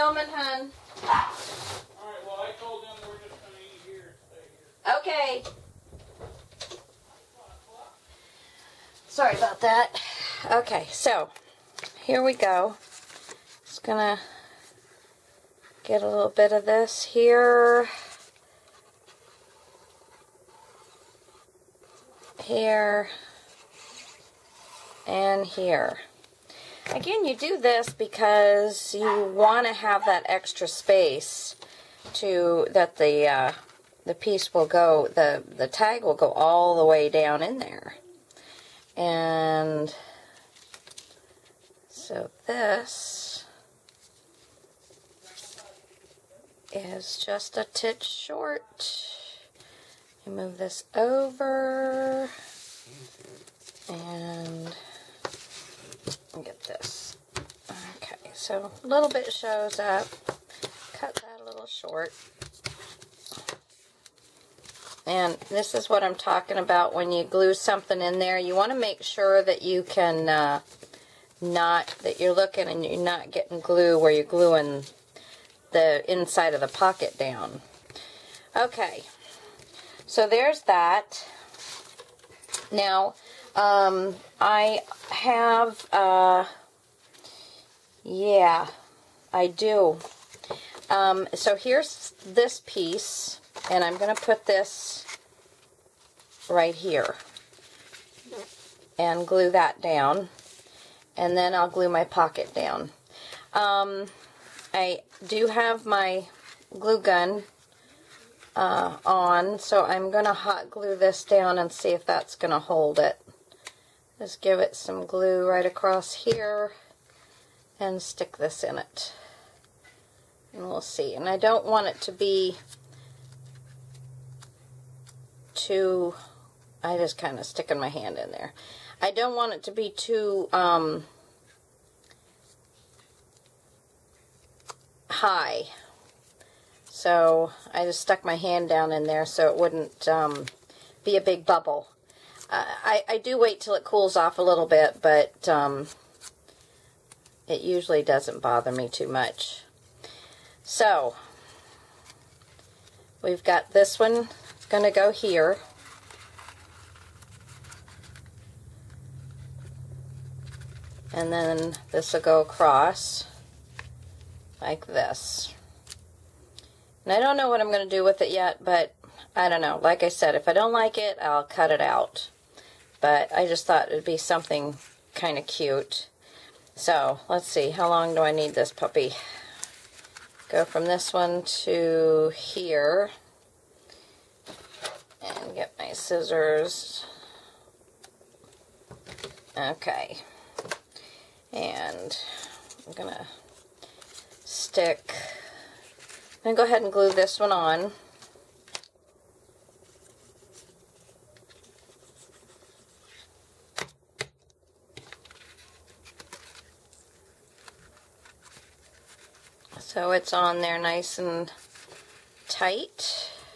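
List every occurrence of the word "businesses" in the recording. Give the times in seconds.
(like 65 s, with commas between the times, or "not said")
not said.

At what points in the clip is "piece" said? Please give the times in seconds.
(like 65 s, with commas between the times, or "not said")
34 s, 92 s.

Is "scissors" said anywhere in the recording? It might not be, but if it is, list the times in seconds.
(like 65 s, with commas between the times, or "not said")
185 s.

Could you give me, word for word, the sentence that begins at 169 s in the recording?
Like I said, if I don't like it, I'll cut it out.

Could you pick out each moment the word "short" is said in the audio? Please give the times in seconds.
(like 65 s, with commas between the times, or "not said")
48 s, 61 s.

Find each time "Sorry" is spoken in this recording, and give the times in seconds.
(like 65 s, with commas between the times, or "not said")
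9 s.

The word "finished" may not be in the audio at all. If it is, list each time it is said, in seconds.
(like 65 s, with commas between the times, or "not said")
not said.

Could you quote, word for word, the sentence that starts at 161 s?
And then this will go across like this.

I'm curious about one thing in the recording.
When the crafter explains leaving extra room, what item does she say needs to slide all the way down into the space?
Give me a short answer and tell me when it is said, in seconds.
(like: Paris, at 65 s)
the tag, at 35 s.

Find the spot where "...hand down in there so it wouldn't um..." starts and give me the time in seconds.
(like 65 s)
138 s.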